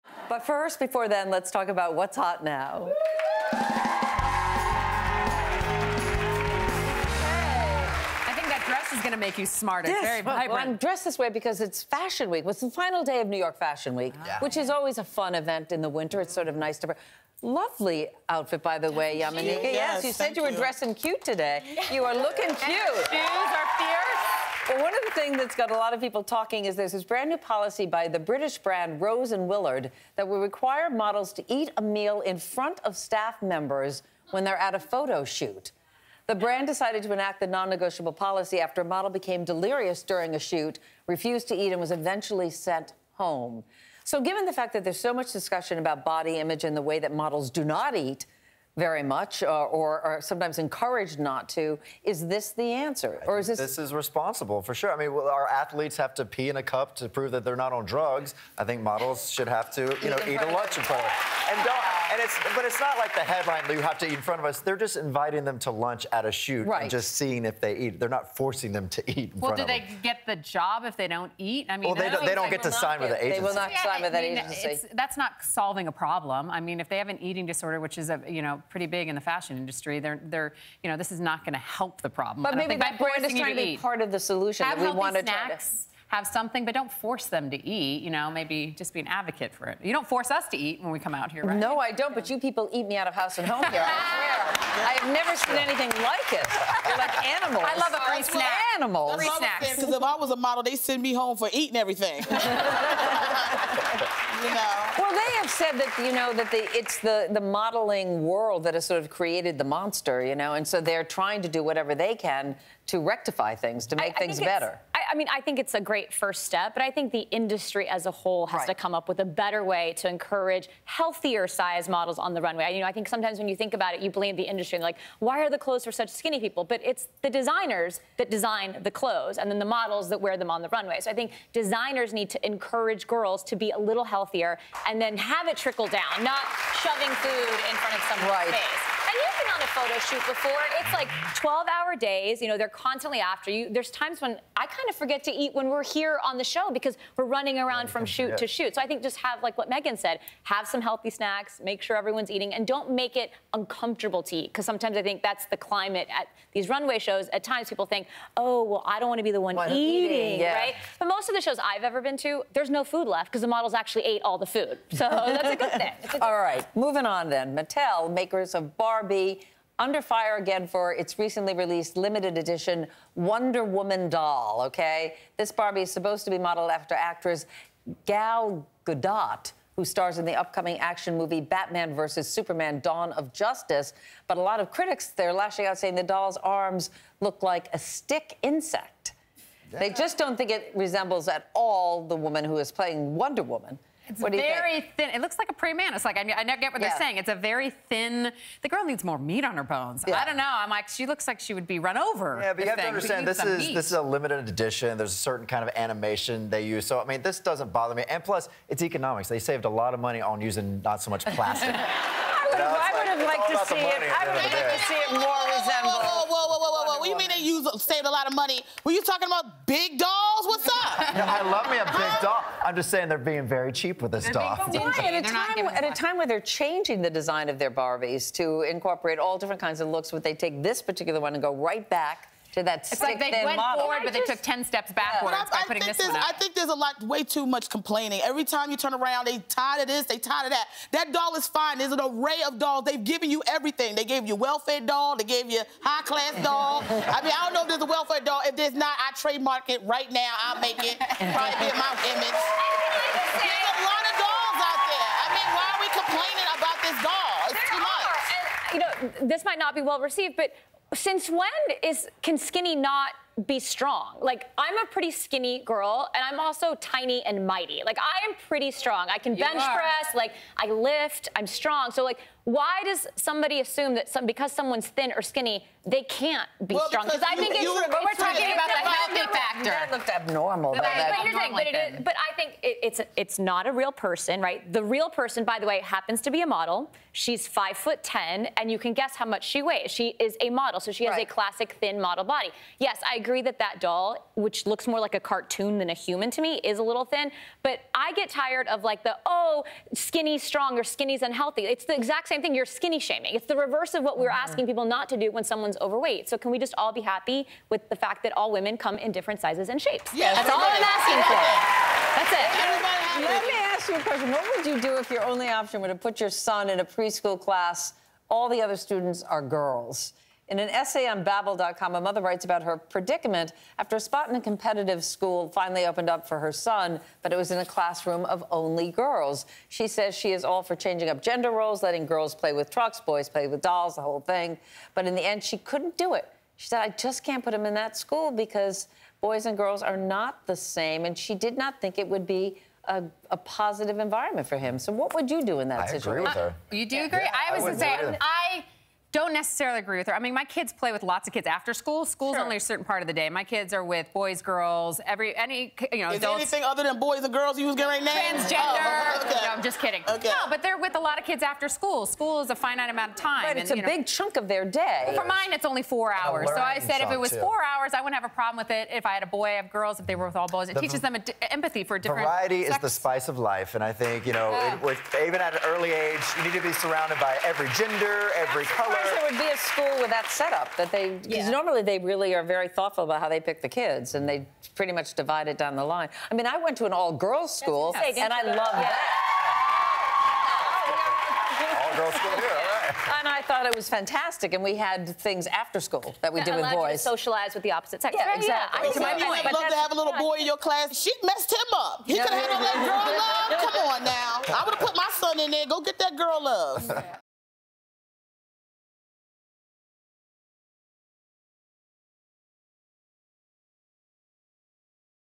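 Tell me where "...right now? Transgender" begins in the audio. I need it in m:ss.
5:58.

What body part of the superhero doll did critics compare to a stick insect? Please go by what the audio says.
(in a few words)
arms.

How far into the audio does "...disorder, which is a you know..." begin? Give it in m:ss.
1:17.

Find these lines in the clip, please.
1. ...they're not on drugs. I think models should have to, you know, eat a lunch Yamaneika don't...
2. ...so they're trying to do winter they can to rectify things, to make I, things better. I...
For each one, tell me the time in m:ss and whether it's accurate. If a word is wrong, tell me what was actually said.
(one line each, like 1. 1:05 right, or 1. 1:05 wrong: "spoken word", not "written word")
1. 0:57 wrong: "And", not "Yamaneika"
2. 1:50 wrong: "whatever", not "winter".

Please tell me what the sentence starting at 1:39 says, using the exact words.
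Because if I was a model, they send me home for eating everything.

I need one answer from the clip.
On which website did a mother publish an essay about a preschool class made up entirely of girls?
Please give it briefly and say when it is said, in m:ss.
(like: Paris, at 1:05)
Babble.com, at 5:21.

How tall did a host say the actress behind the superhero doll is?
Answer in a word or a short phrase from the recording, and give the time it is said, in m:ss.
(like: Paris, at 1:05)
5 foot 10, at 4:47.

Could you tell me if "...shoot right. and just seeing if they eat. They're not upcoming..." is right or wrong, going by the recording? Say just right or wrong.
wrong.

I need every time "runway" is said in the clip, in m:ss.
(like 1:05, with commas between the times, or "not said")
2:02, 2:10, 2:36.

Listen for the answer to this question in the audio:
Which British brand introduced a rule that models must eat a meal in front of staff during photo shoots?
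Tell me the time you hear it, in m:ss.
0:29.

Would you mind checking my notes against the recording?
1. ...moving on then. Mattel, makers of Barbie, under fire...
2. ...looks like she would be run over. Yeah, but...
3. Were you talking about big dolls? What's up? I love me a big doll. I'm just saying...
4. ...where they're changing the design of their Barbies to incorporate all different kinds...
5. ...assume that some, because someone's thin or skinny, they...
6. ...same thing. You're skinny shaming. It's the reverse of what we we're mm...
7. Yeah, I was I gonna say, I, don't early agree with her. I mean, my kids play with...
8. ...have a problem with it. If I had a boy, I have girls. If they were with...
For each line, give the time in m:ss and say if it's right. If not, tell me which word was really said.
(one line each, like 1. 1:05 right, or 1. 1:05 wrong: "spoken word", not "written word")
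1. 2:46 right
2. 3:21 right
3. 3:38 right
4. 3:46 right
5. 4:33 right
6. 5:02 right
7. 5:47 wrong: "necessarily", not "early"
8. 6:08 right.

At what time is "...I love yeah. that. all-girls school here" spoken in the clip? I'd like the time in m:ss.
6:28.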